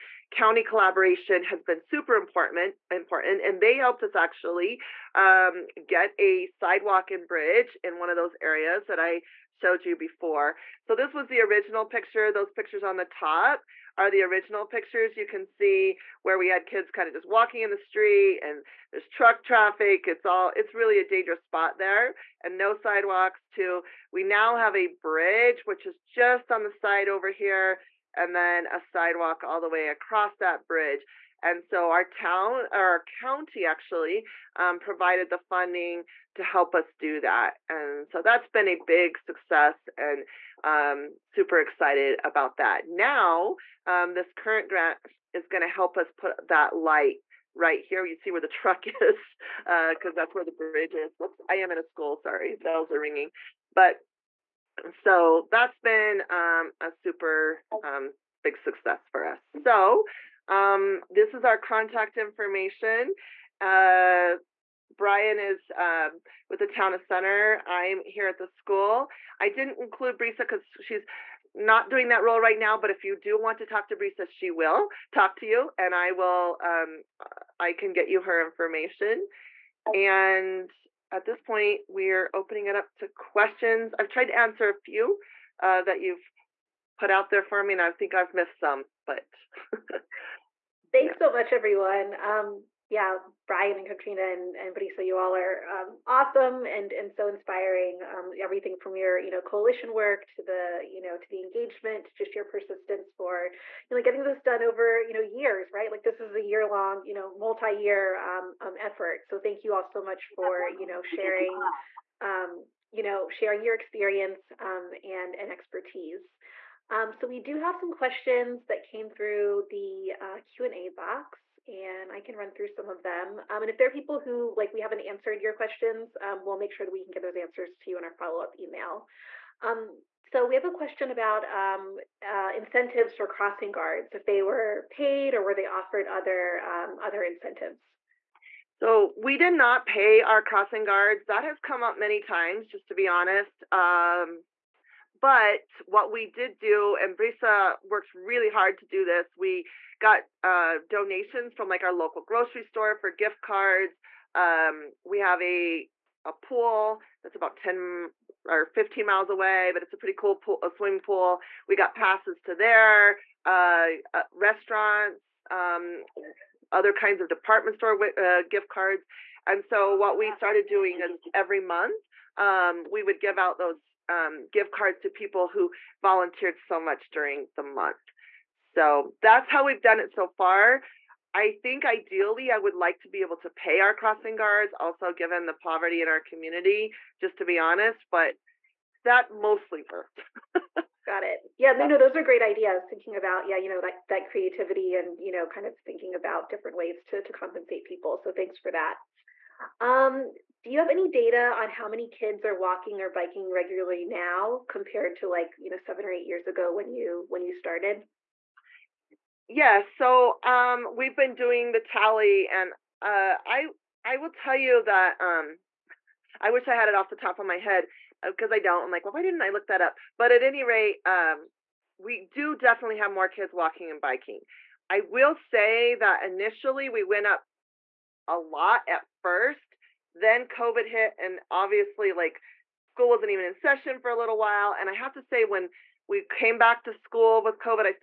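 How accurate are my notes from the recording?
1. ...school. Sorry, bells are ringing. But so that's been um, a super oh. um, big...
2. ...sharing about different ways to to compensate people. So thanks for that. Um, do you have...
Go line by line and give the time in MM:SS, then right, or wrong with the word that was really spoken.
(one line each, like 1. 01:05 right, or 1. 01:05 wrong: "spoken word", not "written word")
1. 00:51 right
2. 03:15 wrong: "thinking", not "sharing".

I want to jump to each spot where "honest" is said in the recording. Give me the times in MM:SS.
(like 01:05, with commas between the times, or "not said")
02:23, 03:07.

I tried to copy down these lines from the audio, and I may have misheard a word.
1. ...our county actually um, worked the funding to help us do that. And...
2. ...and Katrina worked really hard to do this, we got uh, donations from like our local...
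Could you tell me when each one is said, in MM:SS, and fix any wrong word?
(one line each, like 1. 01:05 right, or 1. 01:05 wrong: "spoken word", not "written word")
1. 00:32 wrong: "provided", not "worked"
2. 02:26 wrong: "Brisa", not "Katrina".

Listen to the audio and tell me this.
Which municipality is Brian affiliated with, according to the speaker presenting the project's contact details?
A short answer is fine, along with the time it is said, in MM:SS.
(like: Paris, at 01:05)
Town of Center, at 01:06.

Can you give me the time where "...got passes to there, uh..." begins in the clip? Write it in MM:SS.
02:41.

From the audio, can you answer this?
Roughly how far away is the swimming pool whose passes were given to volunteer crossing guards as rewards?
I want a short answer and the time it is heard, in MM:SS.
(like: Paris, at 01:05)
10 or 15 miles, at 02:37.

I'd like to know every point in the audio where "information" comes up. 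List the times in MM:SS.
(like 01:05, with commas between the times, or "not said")
01:02, 01:18.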